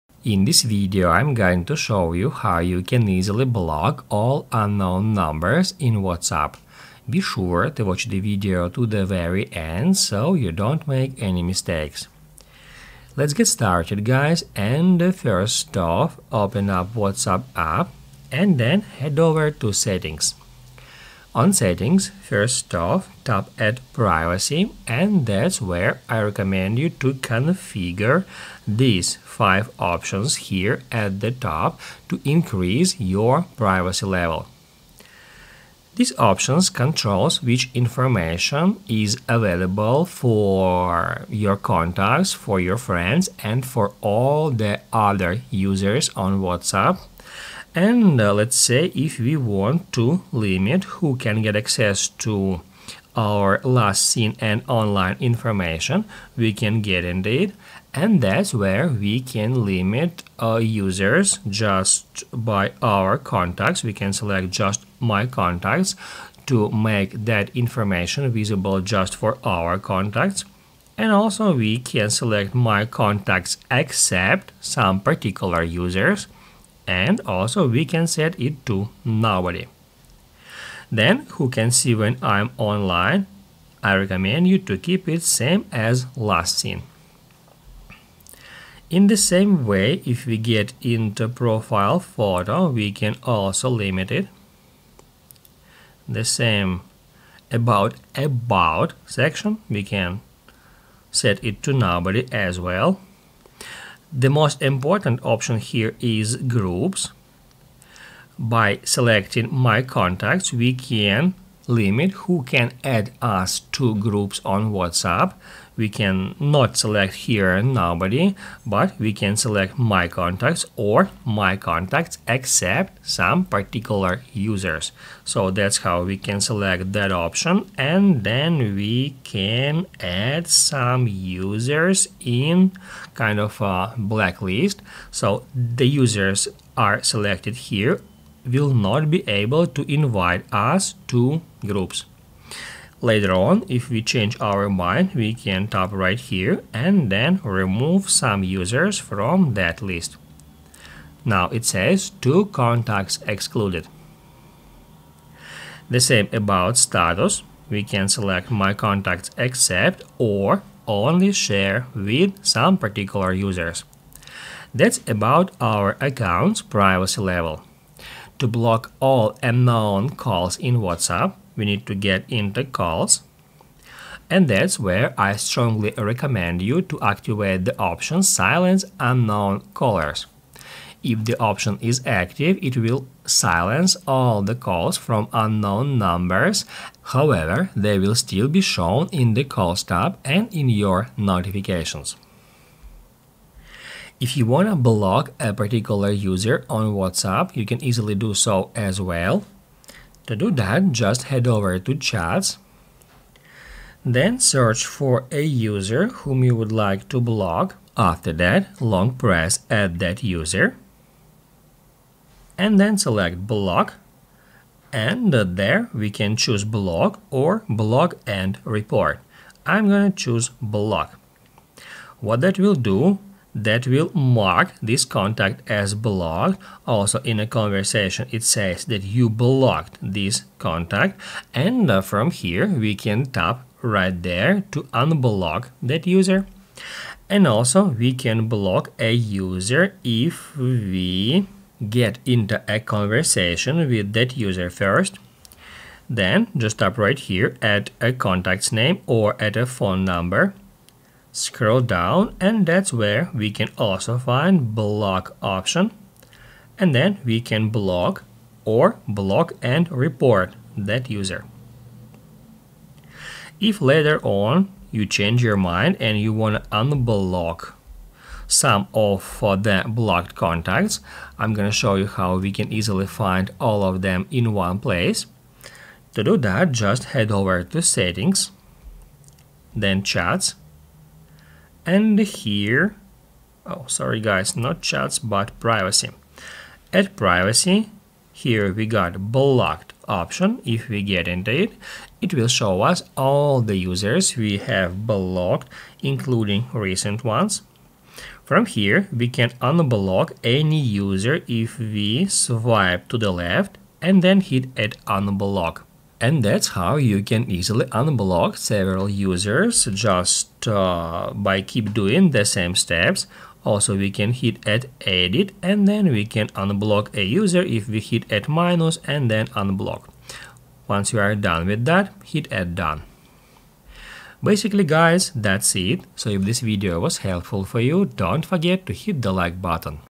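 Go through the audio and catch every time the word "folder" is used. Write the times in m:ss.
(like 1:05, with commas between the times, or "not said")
not said.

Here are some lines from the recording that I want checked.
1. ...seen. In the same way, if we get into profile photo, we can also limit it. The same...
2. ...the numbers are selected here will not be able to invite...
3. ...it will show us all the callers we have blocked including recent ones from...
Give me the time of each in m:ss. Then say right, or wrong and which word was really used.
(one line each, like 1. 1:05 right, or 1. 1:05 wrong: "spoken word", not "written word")
1. 1:26 right
2. 2:15 wrong: "users", not "numbers"
3. 4:52 wrong: "users", not "callers".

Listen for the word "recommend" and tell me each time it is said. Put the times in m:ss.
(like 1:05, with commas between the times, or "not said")
0:26, 1:23, 2:55.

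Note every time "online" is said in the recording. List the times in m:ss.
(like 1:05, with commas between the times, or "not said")
0:54, 1:22.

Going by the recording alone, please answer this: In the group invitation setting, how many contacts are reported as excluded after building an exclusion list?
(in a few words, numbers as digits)
2.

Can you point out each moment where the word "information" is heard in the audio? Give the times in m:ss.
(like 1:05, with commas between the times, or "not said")
0:37, 0:55, 1:07.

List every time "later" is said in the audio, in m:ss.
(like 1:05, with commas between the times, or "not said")
2:23, 4:23.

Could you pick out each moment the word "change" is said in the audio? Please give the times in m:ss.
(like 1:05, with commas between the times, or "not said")
2:24, 4:25.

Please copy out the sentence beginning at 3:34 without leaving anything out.
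And there we can choose block or block and report.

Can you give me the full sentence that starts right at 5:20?
Once you are done with that, hit at done.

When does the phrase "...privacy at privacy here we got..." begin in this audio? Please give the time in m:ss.
4:45.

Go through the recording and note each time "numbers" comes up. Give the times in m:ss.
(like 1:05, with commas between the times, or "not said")
0:05, 3:05, 4:10.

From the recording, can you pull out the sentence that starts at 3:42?
What that will do that will mark this contact as blocked.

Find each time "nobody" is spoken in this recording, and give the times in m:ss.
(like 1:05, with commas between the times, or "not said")
1:19, 1:41, 1:57.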